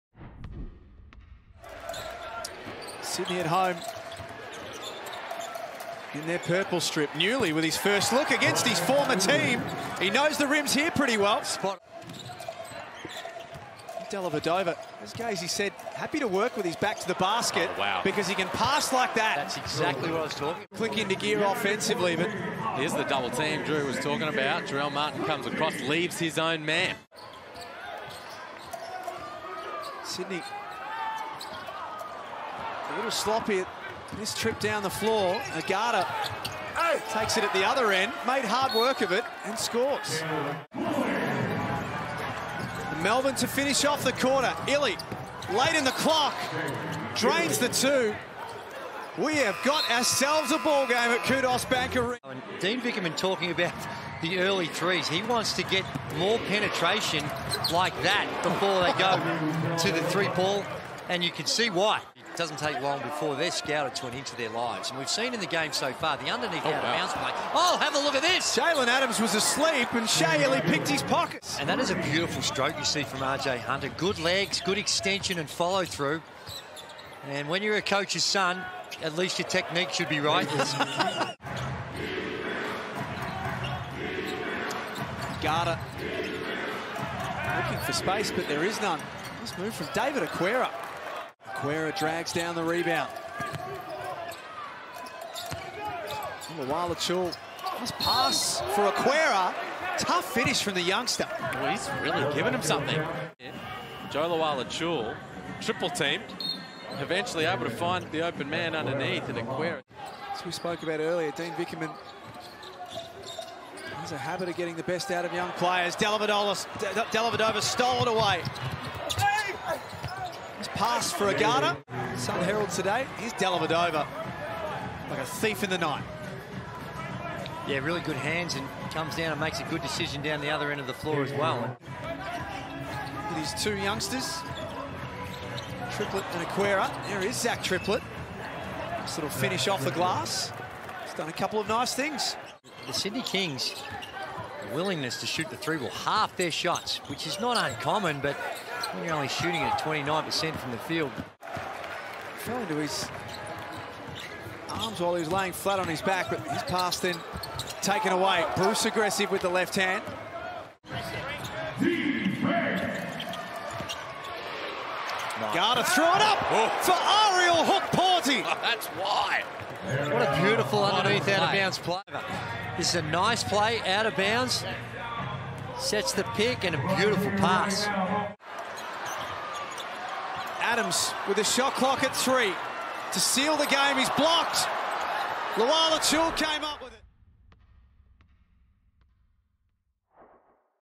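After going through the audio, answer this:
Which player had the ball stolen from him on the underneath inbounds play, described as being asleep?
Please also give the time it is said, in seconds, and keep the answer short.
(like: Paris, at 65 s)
Jaylen Adams, at 68 s.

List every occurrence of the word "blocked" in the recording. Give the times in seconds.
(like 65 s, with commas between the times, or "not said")
184 s.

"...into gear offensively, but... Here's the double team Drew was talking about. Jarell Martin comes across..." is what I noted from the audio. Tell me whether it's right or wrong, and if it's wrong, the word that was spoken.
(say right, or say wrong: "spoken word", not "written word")
right.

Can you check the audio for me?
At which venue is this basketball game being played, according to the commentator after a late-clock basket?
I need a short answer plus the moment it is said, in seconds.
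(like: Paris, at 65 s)
Kudos Bank Arena, at 51 s.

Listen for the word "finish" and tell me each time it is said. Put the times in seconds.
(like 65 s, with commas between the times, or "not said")
43 s, 100 s, 139 s.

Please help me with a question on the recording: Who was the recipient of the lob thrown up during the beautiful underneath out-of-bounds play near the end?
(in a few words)
Ariel Hukporti.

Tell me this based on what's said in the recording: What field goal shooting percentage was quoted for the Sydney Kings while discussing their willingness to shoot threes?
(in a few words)
29%.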